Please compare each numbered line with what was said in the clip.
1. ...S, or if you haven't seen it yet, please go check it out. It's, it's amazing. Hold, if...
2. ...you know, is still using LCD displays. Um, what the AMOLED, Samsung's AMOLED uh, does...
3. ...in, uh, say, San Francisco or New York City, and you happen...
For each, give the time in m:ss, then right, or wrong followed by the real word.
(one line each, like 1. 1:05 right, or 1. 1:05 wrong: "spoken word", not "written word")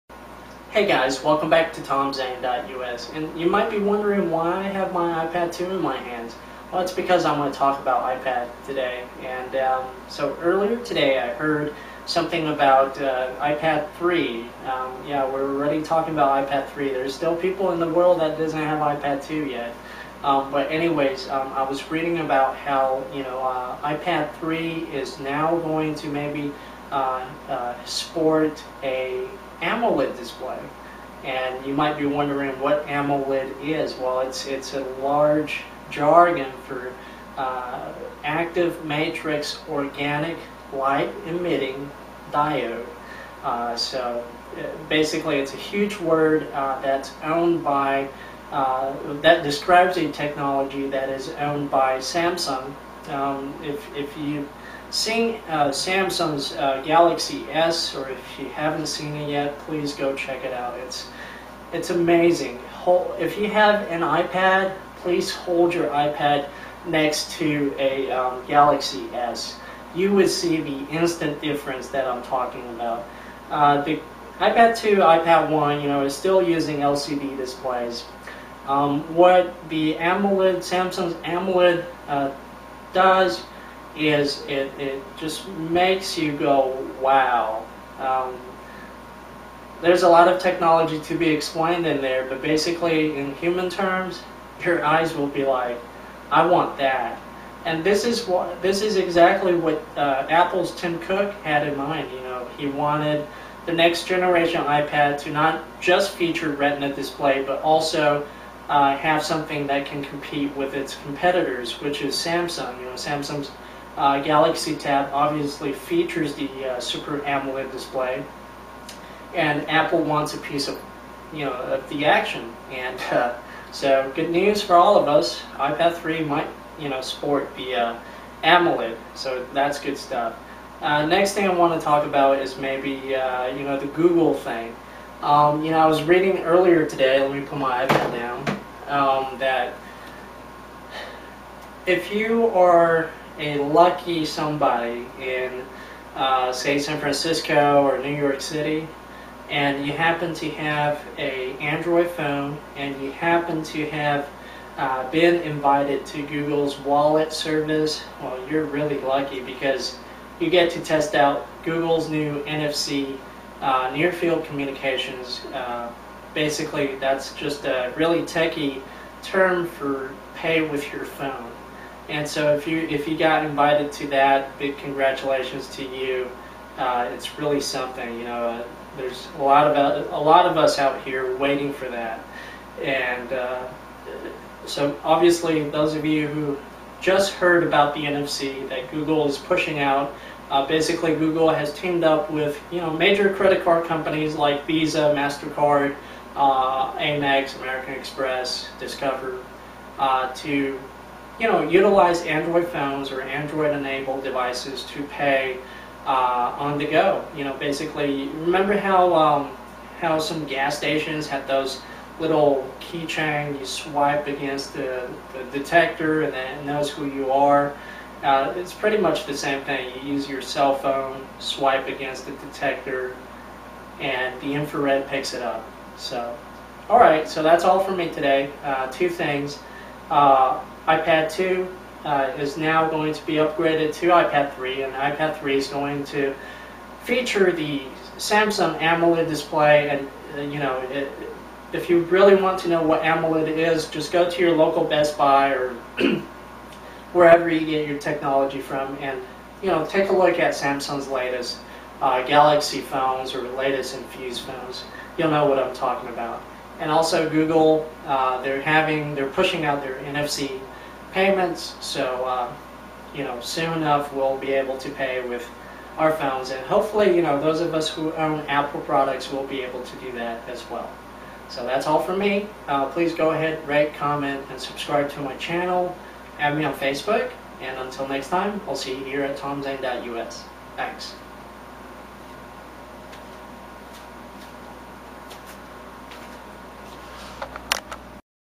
1. 0:57 right
2. 1:15 right
3. 2:25 right.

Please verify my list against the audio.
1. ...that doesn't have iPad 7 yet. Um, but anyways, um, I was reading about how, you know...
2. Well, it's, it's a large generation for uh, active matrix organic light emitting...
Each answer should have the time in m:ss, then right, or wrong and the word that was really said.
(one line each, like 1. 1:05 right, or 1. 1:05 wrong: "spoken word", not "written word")
1. 0:18 wrong: "2", not "7"
2. 0:33 wrong: "jargon", not "generation".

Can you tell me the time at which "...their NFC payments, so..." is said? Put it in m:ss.
4:19.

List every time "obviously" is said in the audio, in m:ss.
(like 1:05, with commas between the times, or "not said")
1:55, 3:05.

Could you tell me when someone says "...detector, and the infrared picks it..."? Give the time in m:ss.
3:42.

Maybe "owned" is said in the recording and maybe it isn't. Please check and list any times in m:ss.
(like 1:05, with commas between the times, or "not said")
0:47, 0:51.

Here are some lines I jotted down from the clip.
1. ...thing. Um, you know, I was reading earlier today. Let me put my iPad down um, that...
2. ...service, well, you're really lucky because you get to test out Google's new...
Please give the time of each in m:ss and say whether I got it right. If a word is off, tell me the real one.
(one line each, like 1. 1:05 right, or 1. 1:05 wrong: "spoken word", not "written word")
1. 2:14 right
2. 2:37 right.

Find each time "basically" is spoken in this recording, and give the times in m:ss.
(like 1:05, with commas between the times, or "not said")
0:44, 1:32, 2:46, 3:10, 3:27.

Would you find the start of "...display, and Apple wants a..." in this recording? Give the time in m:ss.
1:57.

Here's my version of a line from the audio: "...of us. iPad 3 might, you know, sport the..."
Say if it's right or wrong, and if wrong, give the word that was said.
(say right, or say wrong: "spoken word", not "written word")
right.